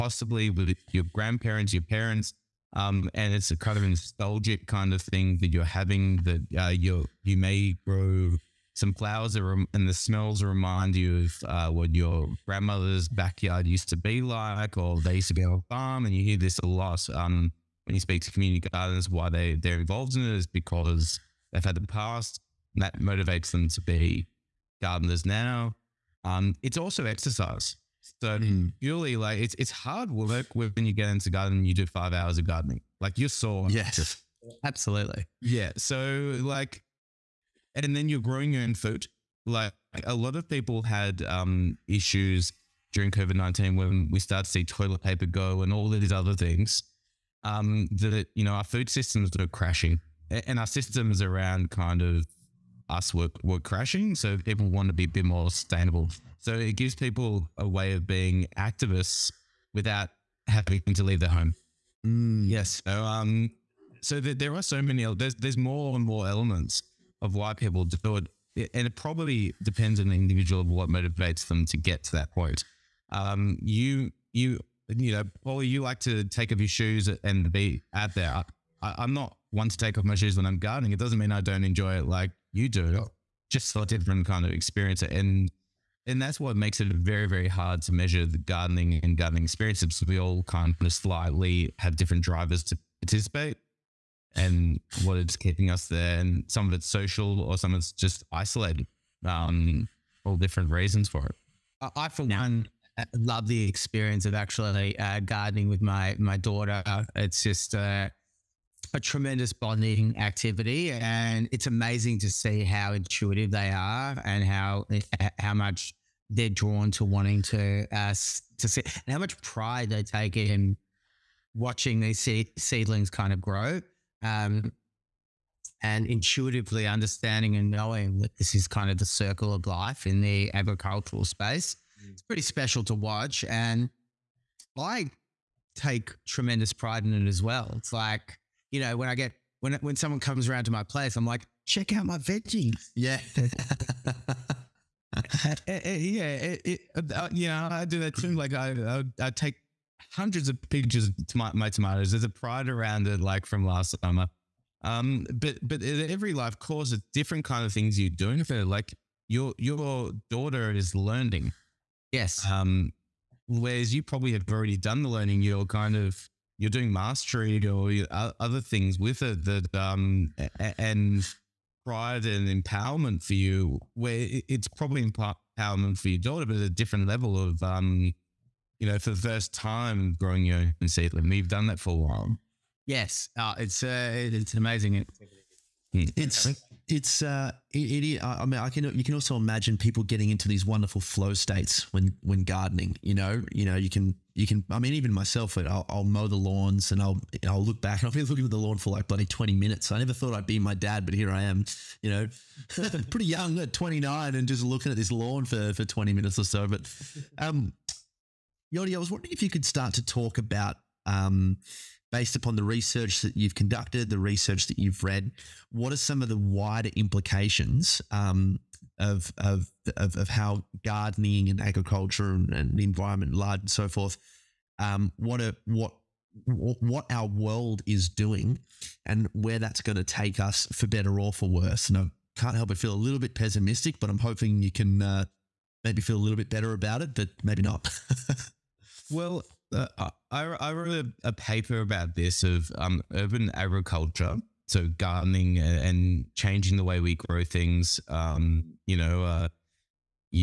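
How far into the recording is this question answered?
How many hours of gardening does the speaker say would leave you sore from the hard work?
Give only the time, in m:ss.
0:31.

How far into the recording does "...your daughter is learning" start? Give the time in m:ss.
2:39.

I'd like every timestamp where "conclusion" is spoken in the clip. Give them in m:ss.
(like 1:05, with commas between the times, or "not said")
not said.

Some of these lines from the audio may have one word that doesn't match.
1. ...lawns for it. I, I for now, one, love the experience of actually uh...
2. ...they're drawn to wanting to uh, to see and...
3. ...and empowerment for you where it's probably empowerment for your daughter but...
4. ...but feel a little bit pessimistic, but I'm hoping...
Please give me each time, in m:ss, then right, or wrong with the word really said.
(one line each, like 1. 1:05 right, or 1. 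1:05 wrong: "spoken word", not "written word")
1. 1:40 wrong: "reasons", not "lawns"
2. 1:56 right
3. 2:52 right
4. 3:52 right.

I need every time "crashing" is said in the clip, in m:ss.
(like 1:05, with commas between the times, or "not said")
0:49, 0:53.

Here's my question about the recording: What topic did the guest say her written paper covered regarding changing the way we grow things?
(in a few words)
Urban agriculture.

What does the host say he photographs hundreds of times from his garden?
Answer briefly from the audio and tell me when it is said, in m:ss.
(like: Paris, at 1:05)
Tomatoes, at 2:31.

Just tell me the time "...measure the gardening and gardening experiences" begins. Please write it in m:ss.
1:27.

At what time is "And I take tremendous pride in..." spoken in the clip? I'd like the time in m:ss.
2:13.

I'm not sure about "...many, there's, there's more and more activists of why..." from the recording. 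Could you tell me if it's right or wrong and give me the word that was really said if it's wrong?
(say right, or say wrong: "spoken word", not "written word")
wrong: "elements", not "activists".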